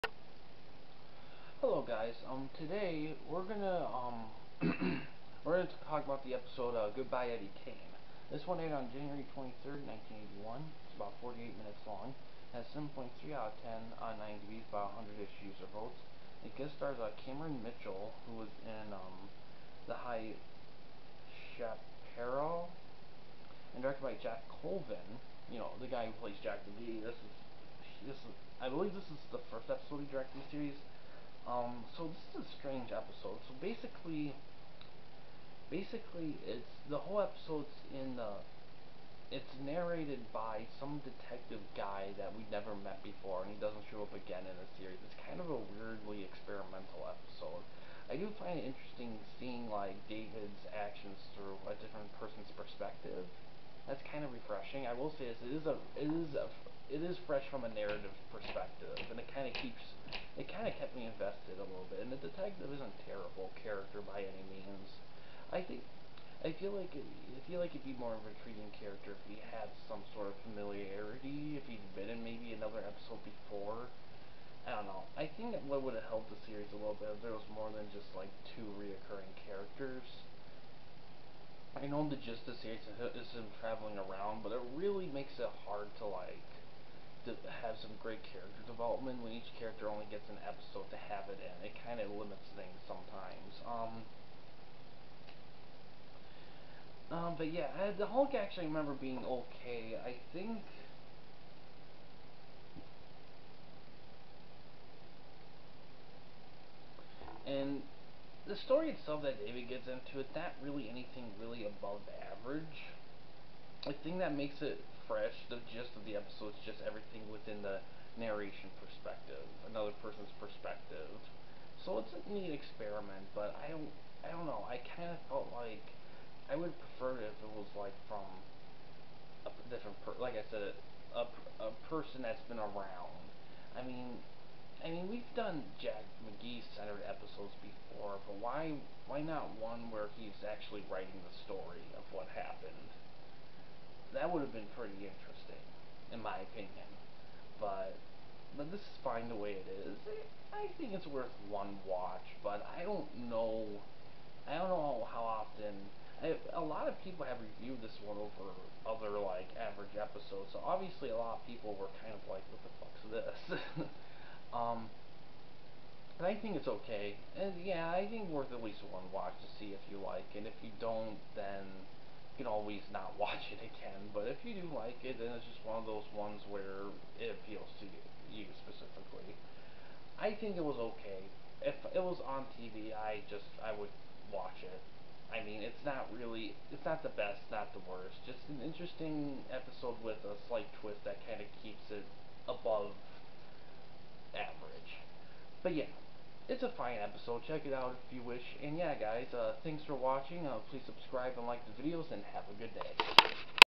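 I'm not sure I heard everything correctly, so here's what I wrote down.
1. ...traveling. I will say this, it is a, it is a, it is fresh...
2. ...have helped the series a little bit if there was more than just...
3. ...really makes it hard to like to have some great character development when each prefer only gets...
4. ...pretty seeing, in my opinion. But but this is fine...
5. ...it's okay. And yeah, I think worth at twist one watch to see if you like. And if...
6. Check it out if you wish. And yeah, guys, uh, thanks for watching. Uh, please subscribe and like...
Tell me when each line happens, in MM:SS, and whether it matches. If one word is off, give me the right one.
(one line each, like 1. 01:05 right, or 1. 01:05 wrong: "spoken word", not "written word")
1. 00:54 wrong: "refreshing", not "traveling"
2. 01:15 right
3. 01:24 wrong: "character", not "prefer"
4. 02:24 wrong: "interesting", not "seeing"
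5. 02:46 wrong: "least", not "twist"
6. 03:17 right.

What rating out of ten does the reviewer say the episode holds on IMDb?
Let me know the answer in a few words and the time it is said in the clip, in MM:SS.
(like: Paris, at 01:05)
7.3, at 00:12.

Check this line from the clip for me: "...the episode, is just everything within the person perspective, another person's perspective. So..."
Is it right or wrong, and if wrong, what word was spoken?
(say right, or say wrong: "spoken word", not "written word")
wrong: "narration", not "person".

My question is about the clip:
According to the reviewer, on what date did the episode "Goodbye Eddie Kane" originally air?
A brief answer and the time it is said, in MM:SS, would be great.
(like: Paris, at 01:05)
January 23rd, 1981, at 00:08.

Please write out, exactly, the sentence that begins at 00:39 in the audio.
It's narrated by some detective guy that we never met before, and he doesn't show up again in the series.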